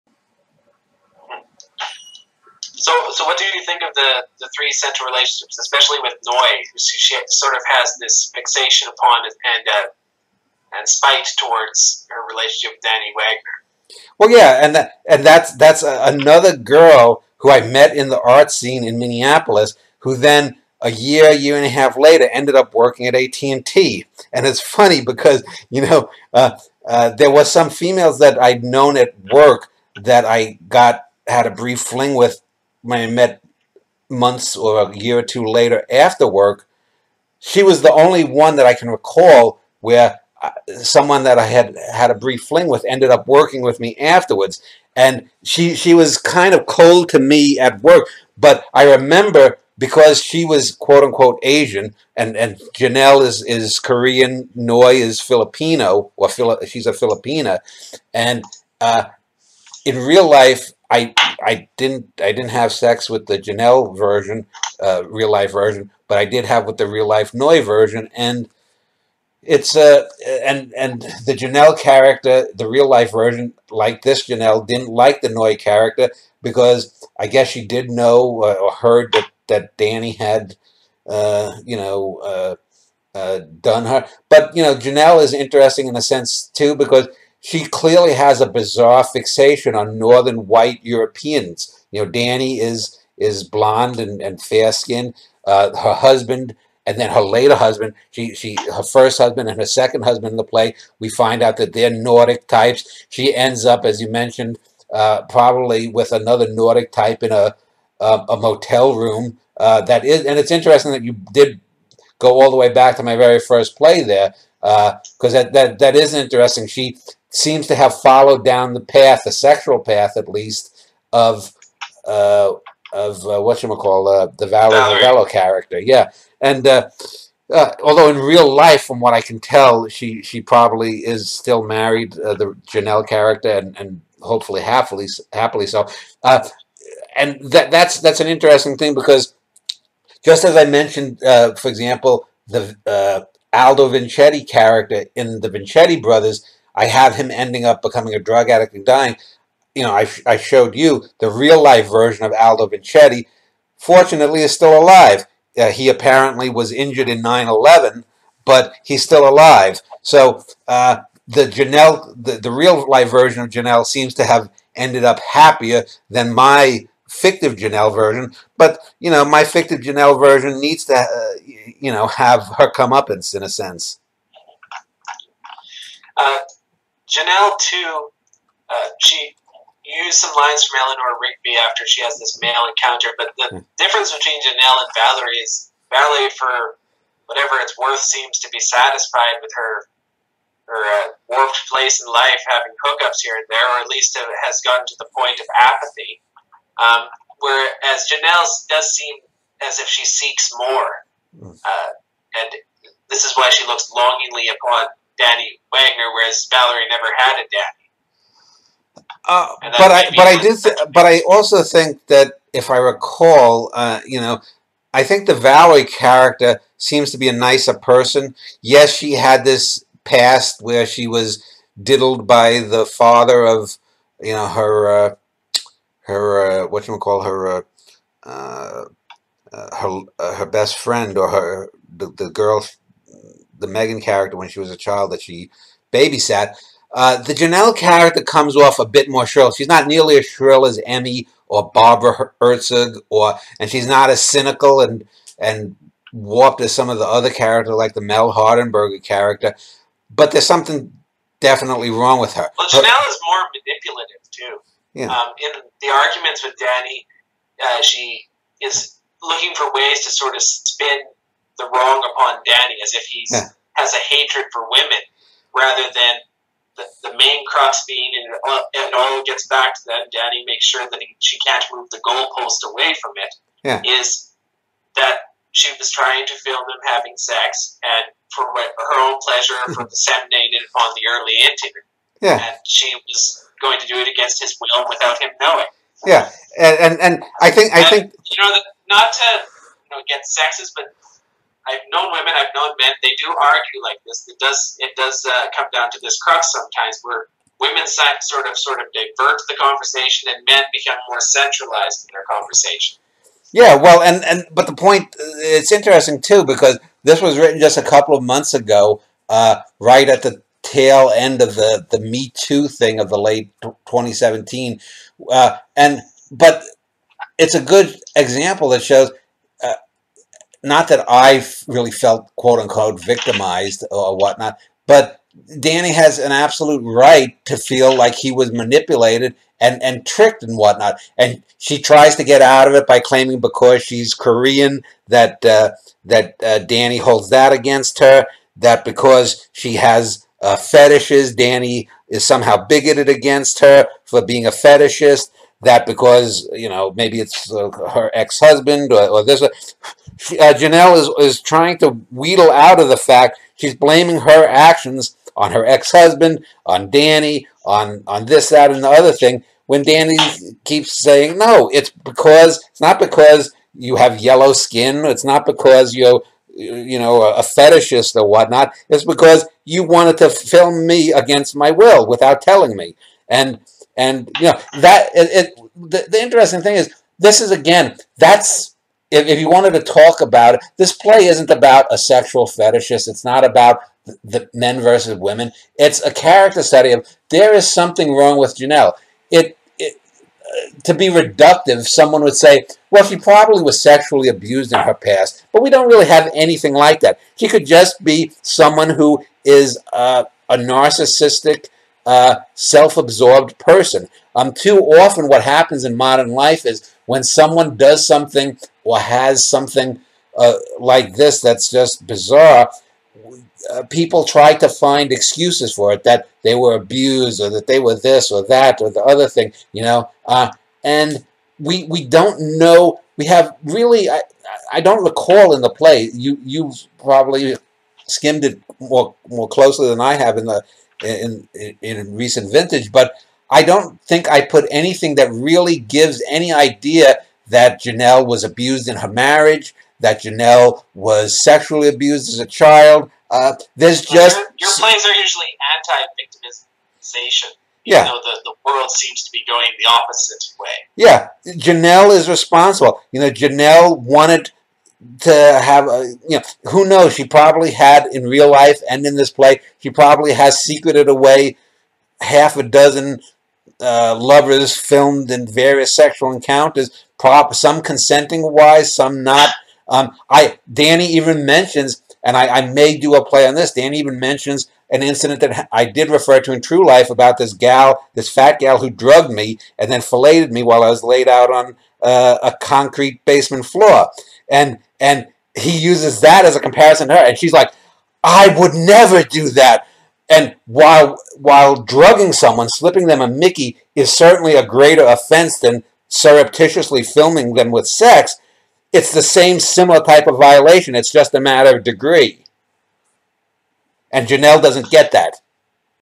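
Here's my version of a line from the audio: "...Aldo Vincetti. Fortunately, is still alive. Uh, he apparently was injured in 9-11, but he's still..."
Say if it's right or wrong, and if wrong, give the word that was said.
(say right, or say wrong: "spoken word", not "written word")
right.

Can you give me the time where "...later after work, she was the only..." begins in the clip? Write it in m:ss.
0:35.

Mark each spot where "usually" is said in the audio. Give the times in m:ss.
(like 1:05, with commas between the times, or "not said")
7:25.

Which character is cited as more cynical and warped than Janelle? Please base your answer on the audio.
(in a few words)
Mel Hardenberger.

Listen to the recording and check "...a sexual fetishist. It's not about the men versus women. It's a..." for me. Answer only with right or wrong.
right.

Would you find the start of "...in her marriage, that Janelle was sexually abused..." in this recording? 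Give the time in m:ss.
7:18.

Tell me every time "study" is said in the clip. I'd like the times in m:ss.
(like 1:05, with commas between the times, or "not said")
6:26.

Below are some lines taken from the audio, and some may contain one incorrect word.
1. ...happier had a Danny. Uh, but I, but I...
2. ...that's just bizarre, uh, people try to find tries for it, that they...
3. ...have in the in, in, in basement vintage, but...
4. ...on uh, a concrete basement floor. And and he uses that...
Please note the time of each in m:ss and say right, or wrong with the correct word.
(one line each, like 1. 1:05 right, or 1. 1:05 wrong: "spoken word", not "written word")
1. 3:26 wrong: "never", not "happier"
2. 6:51 wrong: "excuses", not "tries"
3. 7:10 wrong: "recent", not "basement"
4. 8:01 right.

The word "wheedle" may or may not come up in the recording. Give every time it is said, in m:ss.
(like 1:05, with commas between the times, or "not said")
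5:52.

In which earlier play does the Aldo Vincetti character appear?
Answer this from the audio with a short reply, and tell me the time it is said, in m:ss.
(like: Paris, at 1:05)
The Vincetti Brothers, at 2:25.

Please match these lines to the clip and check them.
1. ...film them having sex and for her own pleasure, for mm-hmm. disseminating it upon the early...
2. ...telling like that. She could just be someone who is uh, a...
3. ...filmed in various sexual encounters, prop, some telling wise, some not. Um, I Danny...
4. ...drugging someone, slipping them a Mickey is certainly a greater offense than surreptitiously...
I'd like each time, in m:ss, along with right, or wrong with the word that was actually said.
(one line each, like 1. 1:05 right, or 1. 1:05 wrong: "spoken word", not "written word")
1. 4:36 right
2. 6:36 wrong: "anything", not "telling"
3. 7:44 wrong: "consenting", not "telling"
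4. 8:11 right.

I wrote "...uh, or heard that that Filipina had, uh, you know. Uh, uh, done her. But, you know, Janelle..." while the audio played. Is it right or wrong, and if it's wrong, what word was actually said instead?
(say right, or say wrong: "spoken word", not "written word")
wrong: "Danny", not "Filipina".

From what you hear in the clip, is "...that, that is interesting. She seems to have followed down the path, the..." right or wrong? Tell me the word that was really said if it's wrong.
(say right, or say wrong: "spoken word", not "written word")
right.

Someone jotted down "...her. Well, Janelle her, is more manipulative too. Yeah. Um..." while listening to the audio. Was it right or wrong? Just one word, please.
right.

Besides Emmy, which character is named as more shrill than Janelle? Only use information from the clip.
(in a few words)
Barbara Herzog.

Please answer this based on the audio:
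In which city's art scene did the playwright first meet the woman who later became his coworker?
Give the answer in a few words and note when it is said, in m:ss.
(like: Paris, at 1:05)
Minneapolis, at 0:18.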